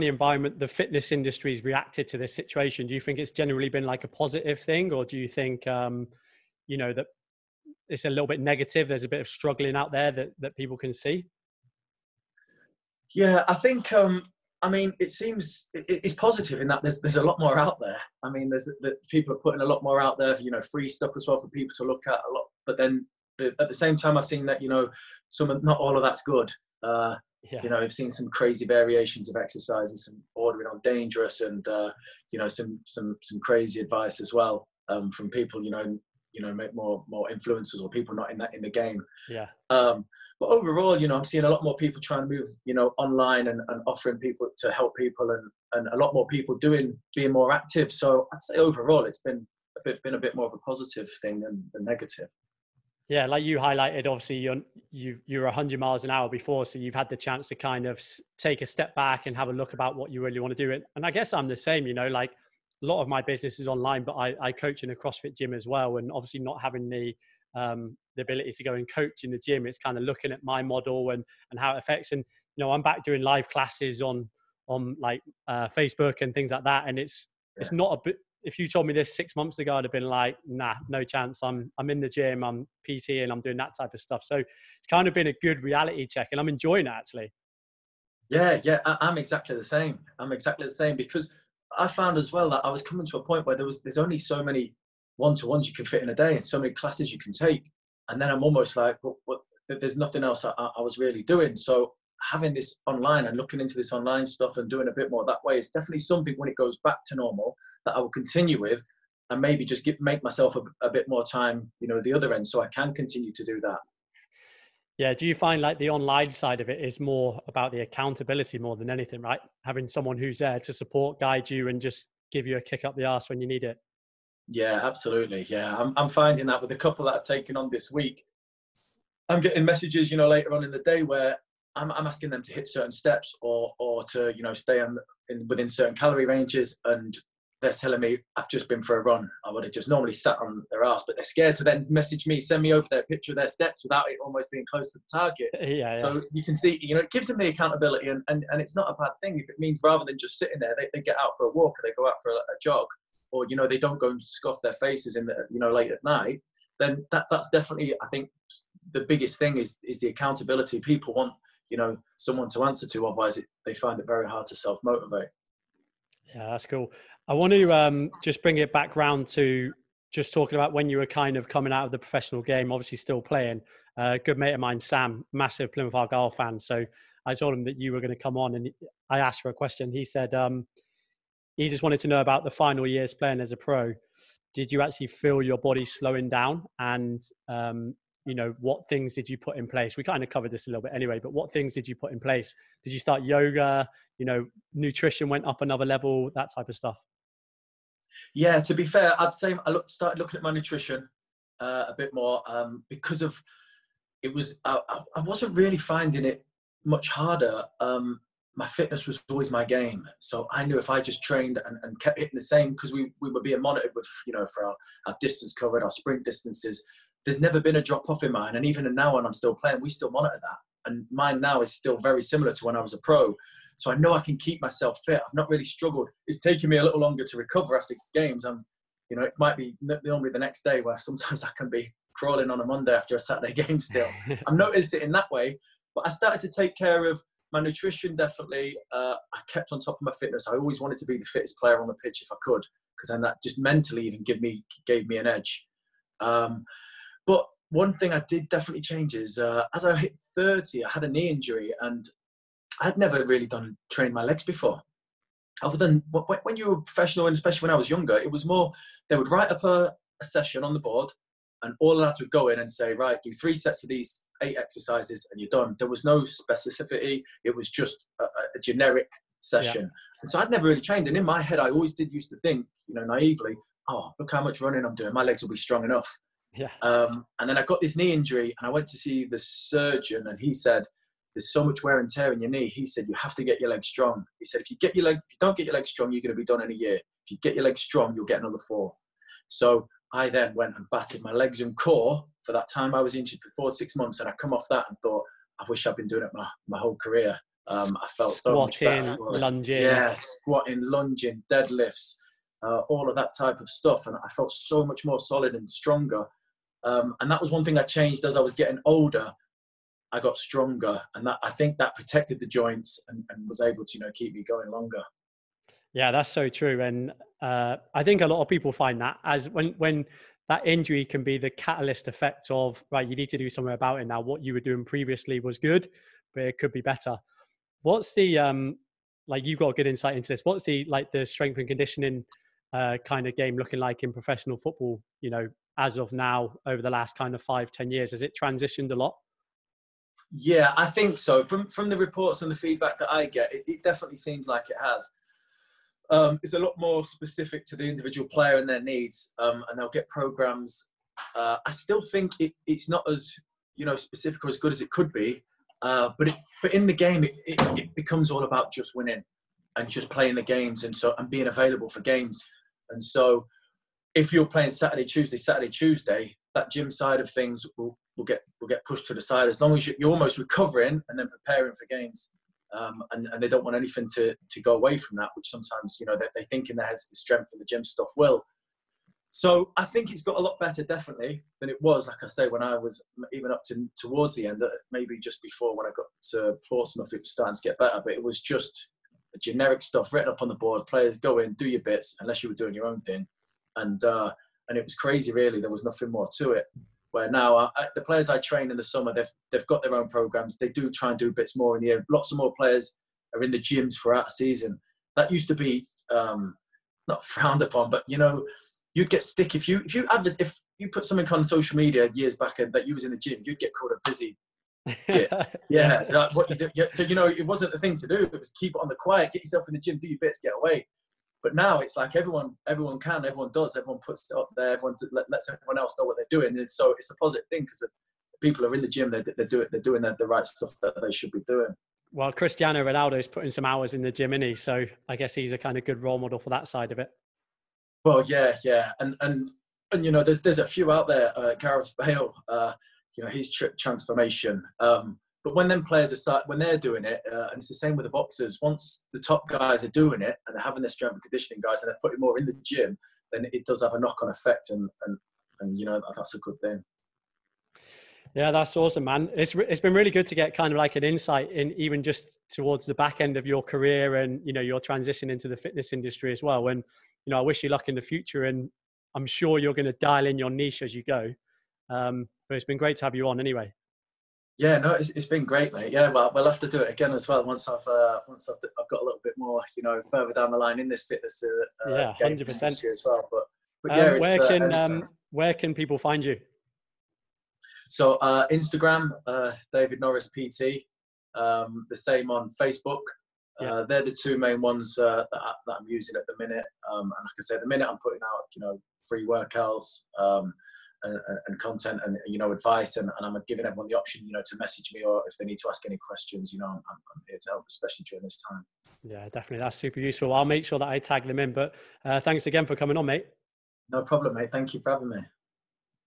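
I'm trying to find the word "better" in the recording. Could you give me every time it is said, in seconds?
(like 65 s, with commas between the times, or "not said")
326 s, 380 s, 387 s.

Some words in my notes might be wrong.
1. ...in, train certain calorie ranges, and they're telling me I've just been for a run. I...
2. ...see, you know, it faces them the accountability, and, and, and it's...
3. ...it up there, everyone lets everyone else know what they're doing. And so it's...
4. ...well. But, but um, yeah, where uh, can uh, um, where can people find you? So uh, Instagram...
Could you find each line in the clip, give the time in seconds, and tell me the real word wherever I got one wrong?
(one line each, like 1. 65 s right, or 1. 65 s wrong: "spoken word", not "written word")
1. 135 s wrong: "within", not "train"
2. 146 s wrong: "gives", not "faces"
3. 424 s right
4. 483 s right.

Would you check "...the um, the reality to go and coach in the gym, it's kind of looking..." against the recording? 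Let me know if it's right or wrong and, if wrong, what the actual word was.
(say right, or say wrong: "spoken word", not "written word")
wrong: "ability", not "reality".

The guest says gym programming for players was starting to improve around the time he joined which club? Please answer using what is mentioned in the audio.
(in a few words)
Portsmouth.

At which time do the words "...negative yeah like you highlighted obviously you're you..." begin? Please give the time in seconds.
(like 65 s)
51 s.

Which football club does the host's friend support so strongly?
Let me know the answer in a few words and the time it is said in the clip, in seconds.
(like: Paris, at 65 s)
Plymouth Argyle, at 175 s.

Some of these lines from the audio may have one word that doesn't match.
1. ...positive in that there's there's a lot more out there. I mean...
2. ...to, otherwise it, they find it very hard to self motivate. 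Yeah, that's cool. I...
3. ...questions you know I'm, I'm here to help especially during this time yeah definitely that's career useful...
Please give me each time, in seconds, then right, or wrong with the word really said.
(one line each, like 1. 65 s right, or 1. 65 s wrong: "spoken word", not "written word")
1. 16 s right
2. 162 s right
3. 505 s wrong: "super", not "career".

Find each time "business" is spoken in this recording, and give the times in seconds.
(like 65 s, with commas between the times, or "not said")
63 s.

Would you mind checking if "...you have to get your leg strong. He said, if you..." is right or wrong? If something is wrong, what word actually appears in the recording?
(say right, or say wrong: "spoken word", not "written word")
right.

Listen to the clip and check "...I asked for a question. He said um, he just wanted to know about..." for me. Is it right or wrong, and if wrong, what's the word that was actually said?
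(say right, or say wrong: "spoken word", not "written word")
right.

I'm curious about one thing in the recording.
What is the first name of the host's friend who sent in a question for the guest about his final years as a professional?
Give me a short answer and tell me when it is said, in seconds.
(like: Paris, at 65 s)
Sam, at 174 s.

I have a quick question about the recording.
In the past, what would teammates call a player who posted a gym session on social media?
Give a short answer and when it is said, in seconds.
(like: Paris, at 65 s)
a busy, at 413 s.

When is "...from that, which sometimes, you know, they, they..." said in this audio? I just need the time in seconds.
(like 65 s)
374 s.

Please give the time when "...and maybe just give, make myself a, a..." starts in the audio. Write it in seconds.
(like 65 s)
109 s.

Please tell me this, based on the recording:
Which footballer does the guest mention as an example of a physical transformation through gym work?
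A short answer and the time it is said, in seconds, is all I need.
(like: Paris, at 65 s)
Gareth Bale, at 441 s.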